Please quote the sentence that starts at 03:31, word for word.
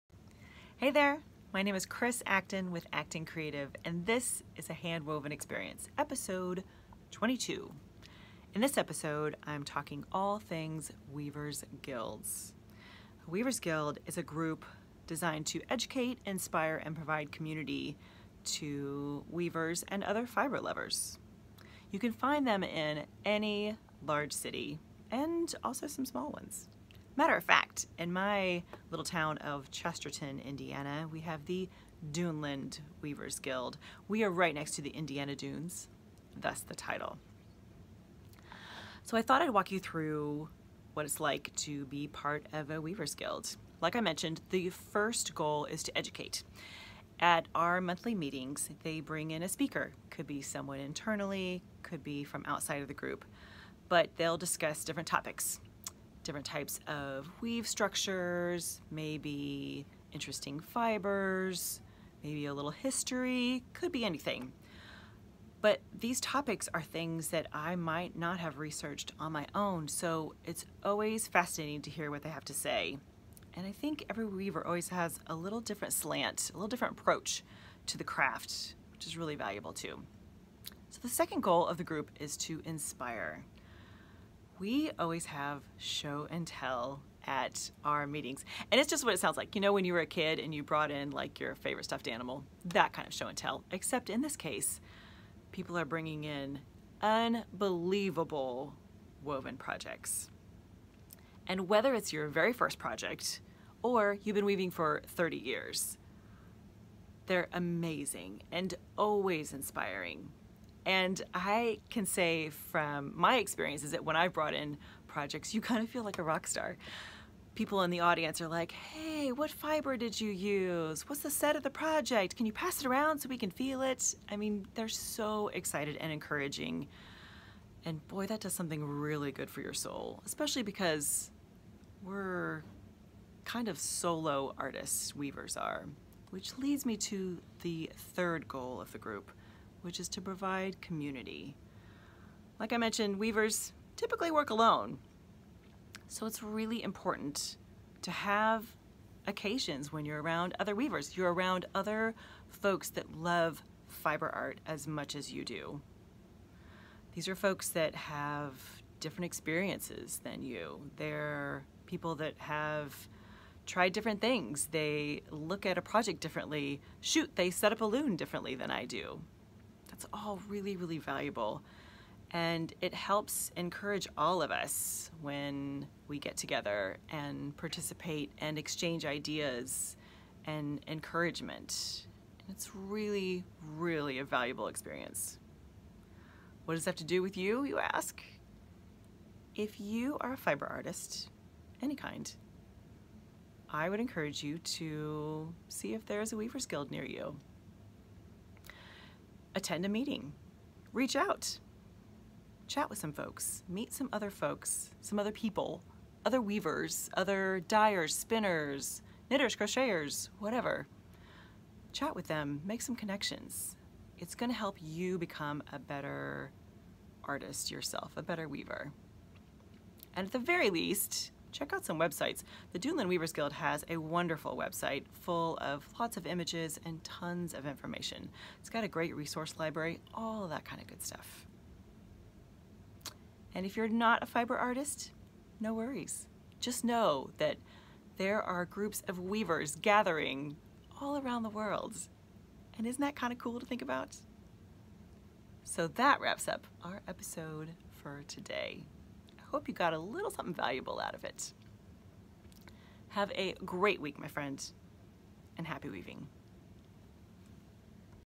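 Chat with them, make some connections.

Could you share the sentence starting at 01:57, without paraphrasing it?
People in the audience are like, hey, what fiber did you use?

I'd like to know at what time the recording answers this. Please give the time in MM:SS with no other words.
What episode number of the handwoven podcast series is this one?
00:05.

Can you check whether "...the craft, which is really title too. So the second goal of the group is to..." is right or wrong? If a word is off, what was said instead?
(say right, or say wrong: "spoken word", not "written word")
wrong: "valuable", not "title".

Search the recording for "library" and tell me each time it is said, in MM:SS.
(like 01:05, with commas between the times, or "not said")
03:49.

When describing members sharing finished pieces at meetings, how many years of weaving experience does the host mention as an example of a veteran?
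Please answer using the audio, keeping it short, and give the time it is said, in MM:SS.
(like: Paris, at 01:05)
30, at 01:45.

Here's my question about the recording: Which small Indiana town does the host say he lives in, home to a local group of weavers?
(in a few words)
Chesterton.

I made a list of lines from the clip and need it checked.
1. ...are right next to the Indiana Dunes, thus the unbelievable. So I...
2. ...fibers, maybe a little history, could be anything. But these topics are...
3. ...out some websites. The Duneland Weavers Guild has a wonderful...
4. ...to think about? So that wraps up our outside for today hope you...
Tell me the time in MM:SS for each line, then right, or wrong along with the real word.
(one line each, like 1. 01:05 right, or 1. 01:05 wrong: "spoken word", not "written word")
1. 00:34 wrong: "title", not "unbelievable"
2. 01:00 right
3. 03:41 right
4. 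04:03 wrong: "episode", not "outside".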